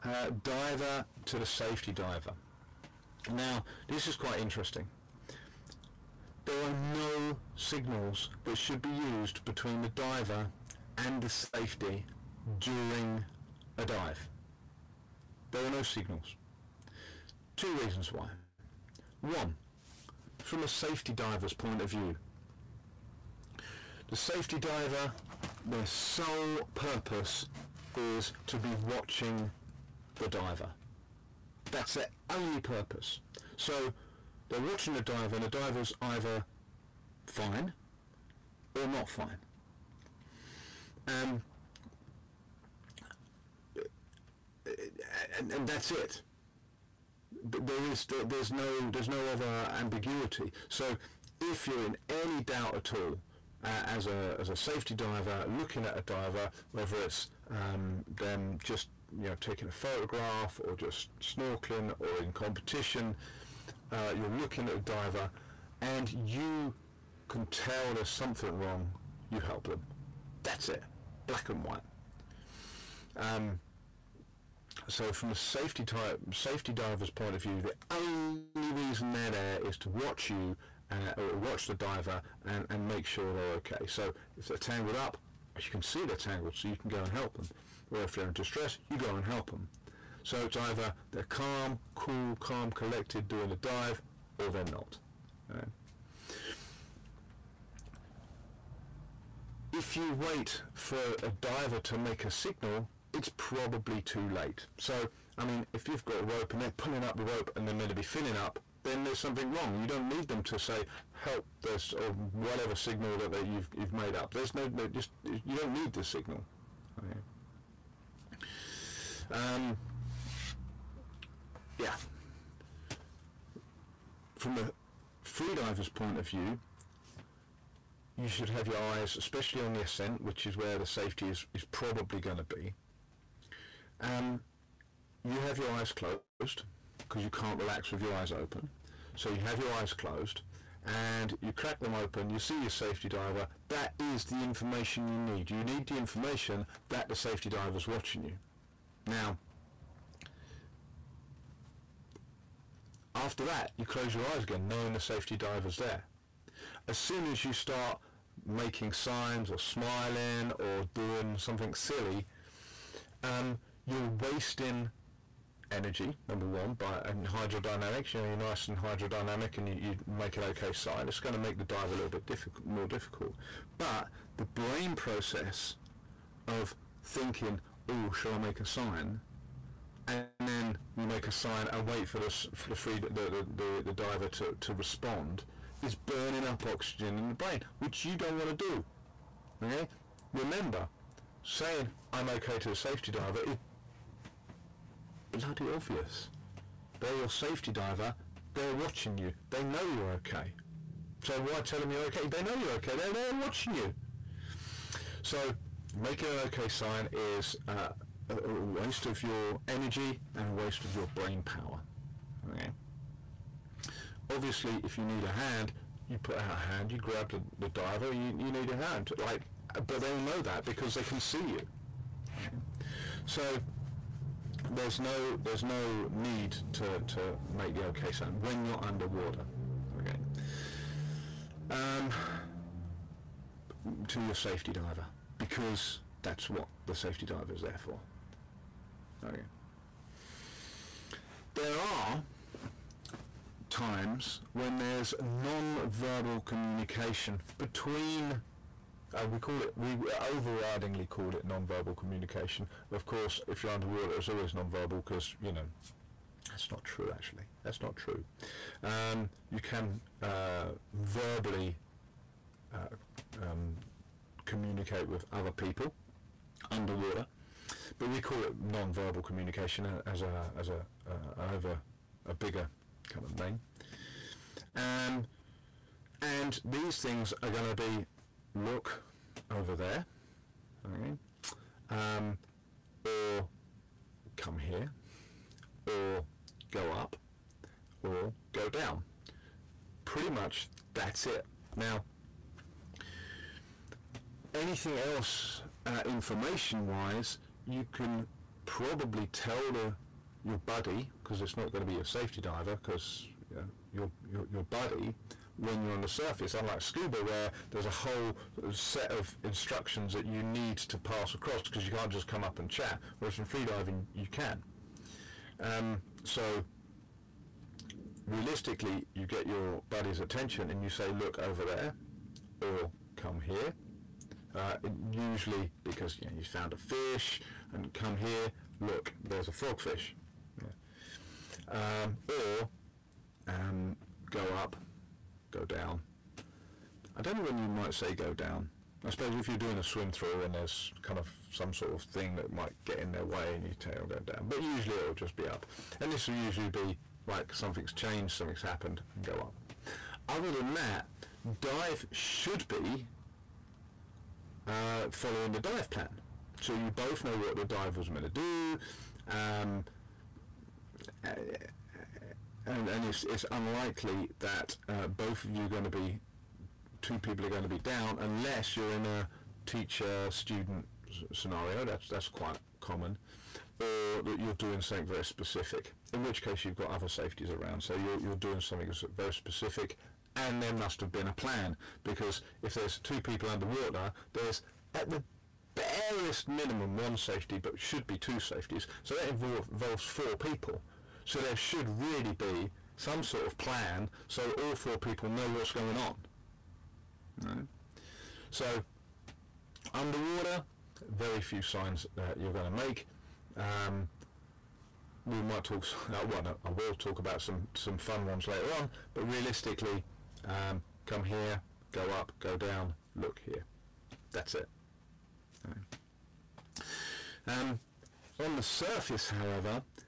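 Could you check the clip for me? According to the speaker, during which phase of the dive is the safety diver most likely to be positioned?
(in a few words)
The ascent.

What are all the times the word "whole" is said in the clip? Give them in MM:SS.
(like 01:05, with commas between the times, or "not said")
05:07.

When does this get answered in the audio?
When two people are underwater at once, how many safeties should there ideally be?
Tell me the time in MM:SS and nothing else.
06:27.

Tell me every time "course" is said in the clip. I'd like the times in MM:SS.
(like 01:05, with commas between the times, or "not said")
04:13.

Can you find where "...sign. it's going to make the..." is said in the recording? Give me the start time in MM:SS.
02:50.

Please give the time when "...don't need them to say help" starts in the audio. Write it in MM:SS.
01:49.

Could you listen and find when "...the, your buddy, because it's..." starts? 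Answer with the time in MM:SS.
04:59.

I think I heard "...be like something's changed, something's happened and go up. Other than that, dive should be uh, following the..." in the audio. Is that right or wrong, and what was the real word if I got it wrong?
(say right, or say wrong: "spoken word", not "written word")
right.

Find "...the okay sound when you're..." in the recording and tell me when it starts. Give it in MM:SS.
03:47.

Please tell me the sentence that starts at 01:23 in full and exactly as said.
So if they're tangled up, as you can see they're tangled, so you can go and help them.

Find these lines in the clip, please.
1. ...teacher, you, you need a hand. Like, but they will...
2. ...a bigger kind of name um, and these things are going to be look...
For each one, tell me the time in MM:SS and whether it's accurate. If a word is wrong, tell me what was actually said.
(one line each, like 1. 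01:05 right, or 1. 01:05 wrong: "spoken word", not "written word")
1. 03:37 wrong: "diver", not "teacher"
2. 04:32 right.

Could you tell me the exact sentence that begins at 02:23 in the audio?
That is the information you need.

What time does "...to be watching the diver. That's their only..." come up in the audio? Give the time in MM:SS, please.
00:28.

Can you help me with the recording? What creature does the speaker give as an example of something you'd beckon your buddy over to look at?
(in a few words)
Frogfish.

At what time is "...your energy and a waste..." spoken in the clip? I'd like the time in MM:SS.
03:29.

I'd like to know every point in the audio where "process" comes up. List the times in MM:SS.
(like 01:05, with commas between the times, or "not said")
02:54.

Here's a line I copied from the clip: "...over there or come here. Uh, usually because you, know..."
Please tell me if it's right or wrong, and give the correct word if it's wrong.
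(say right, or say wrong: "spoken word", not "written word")
right.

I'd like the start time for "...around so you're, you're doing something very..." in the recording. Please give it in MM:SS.
06:17.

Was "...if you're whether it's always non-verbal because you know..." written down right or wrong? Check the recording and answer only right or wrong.
wrong.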